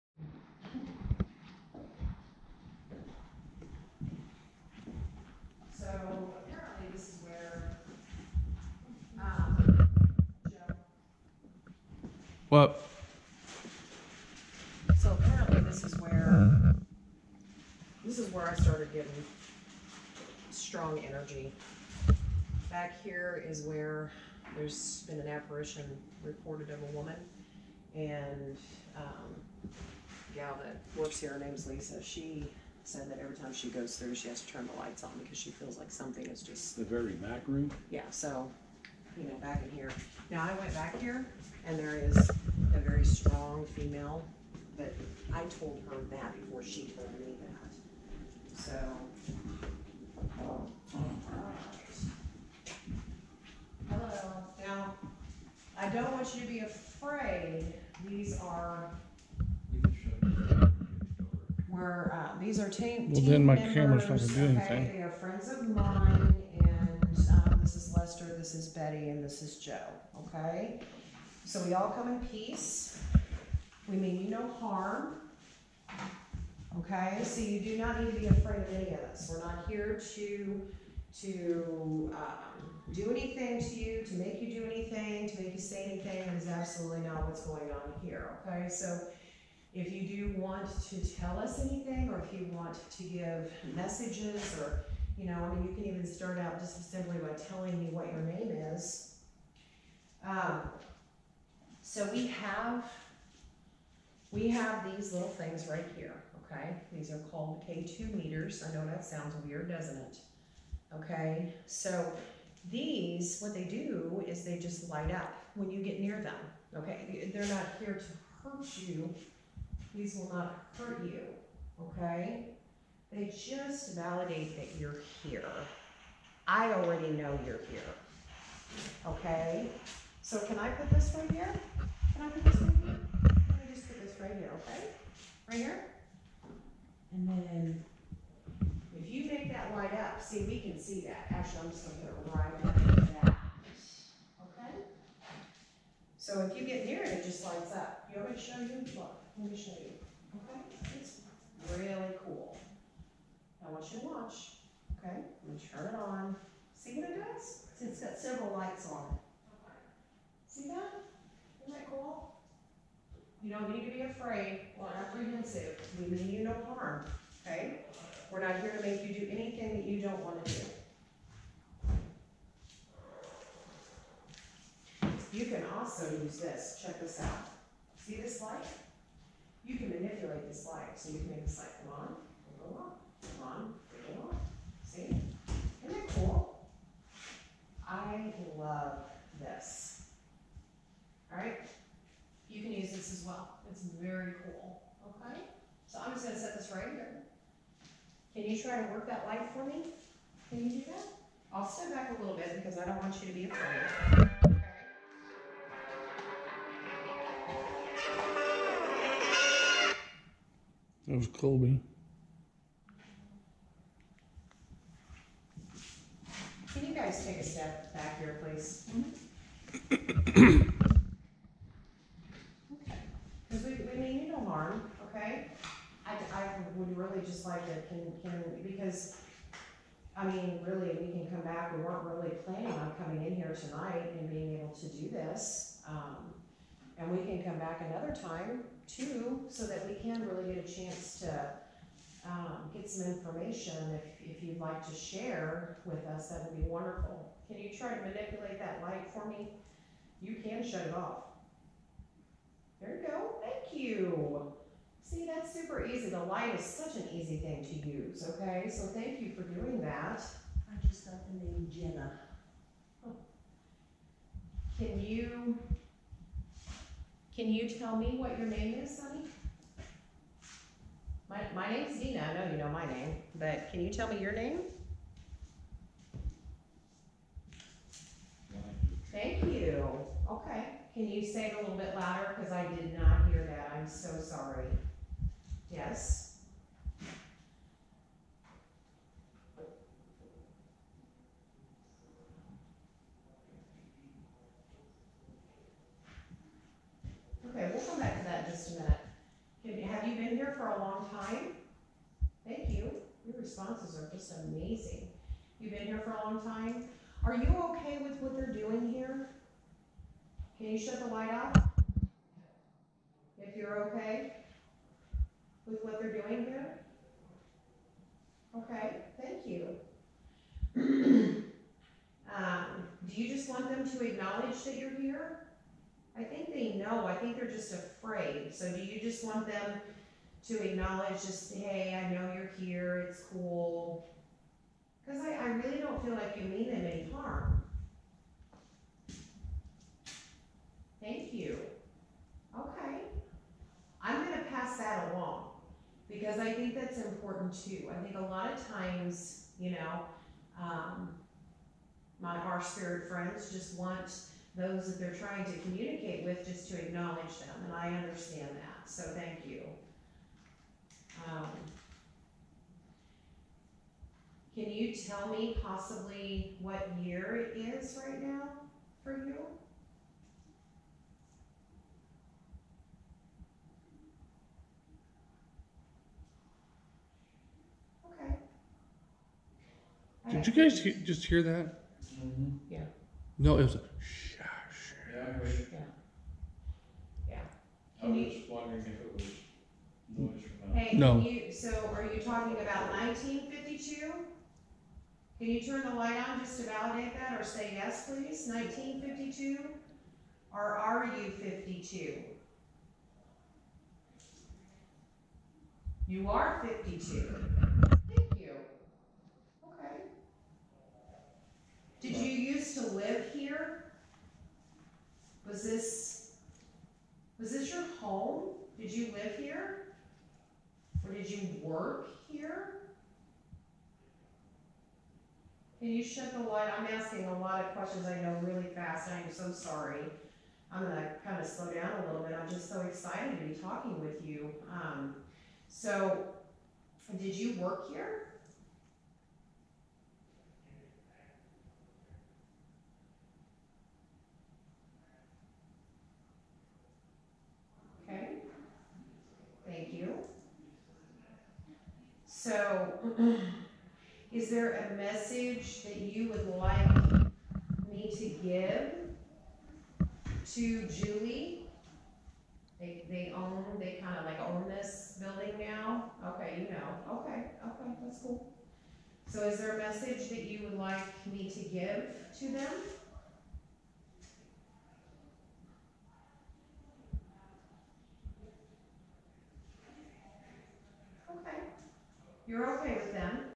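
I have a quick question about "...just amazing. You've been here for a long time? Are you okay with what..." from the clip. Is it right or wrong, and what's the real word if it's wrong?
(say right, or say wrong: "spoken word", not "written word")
right.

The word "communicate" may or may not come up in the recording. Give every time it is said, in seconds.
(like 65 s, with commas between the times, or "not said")
355 s.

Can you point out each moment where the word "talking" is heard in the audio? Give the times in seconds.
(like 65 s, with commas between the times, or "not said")
392 s, 433 s.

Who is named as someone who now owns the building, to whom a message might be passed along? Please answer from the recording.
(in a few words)
Julie.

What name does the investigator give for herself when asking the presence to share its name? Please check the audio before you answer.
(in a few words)
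Dina.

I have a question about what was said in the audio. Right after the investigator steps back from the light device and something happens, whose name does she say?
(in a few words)
Colby.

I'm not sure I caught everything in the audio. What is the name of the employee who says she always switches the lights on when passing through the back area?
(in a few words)
Lisa.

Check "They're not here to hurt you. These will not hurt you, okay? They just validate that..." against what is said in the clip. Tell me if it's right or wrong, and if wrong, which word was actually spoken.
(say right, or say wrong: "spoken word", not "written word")
right.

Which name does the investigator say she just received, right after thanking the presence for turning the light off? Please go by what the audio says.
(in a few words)
Jenna.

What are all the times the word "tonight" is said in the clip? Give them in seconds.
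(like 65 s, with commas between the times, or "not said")
233 s.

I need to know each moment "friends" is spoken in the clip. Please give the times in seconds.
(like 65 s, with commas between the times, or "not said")
65 s, 353 s.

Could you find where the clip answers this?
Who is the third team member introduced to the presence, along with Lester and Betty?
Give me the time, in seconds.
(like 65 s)
69 s.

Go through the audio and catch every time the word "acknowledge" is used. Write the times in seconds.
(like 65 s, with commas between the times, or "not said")
324 s, 330 s, 356 s.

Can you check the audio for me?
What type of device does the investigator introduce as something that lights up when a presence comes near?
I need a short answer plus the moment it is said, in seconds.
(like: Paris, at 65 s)
K2 meters, at 107 s.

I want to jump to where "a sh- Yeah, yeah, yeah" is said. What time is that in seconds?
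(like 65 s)
383 s.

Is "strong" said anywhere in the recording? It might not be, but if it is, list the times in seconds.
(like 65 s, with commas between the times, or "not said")
20 s, 43 s.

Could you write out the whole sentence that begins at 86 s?
That is absolutely not what's going on here.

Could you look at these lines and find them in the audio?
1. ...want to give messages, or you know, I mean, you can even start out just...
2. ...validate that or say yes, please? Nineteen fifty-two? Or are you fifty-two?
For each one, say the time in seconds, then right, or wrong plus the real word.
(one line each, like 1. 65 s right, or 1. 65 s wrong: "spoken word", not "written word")
1. 92 s right
2. 396 s right.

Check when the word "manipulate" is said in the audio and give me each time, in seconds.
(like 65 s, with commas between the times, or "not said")
179 s, 248 s.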